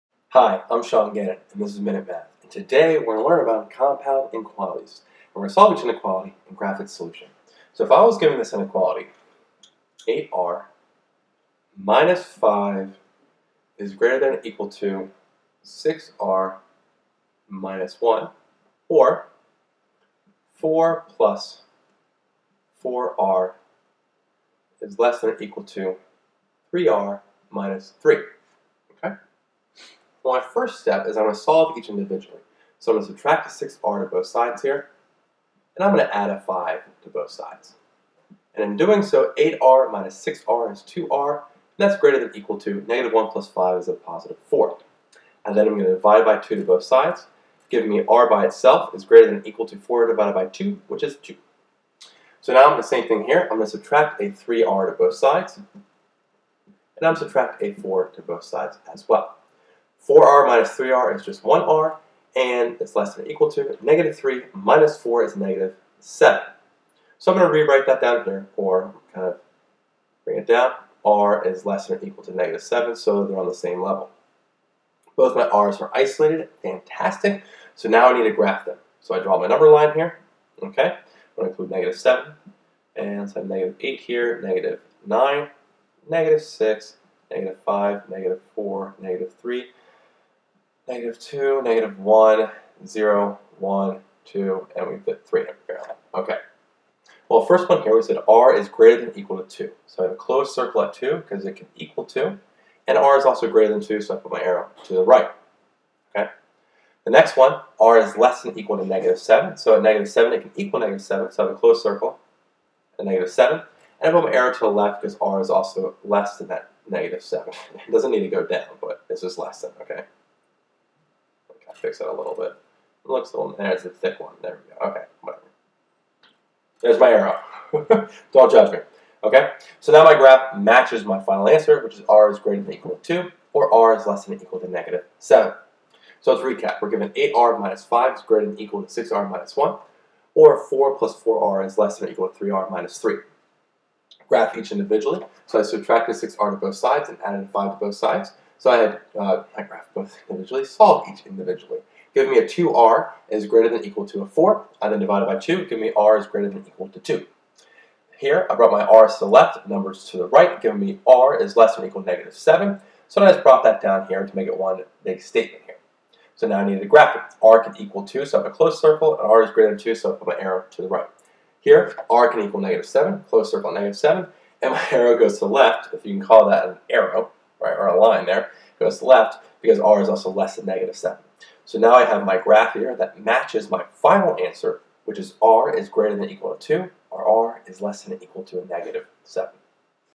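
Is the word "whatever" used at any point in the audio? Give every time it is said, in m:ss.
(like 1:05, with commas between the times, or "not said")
2:05.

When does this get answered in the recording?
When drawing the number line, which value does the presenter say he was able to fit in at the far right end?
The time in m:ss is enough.
1:34.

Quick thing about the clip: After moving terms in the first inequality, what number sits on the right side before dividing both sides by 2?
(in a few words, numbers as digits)
4.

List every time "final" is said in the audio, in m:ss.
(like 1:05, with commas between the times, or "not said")
2:11, 3:03.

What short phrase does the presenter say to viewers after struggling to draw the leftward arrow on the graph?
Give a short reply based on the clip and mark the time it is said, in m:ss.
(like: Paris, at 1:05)
Don't judge me, at 2:08.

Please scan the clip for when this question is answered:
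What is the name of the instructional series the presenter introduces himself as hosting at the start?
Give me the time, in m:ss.
0:01.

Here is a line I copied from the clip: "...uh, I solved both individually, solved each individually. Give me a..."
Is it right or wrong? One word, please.
wrong.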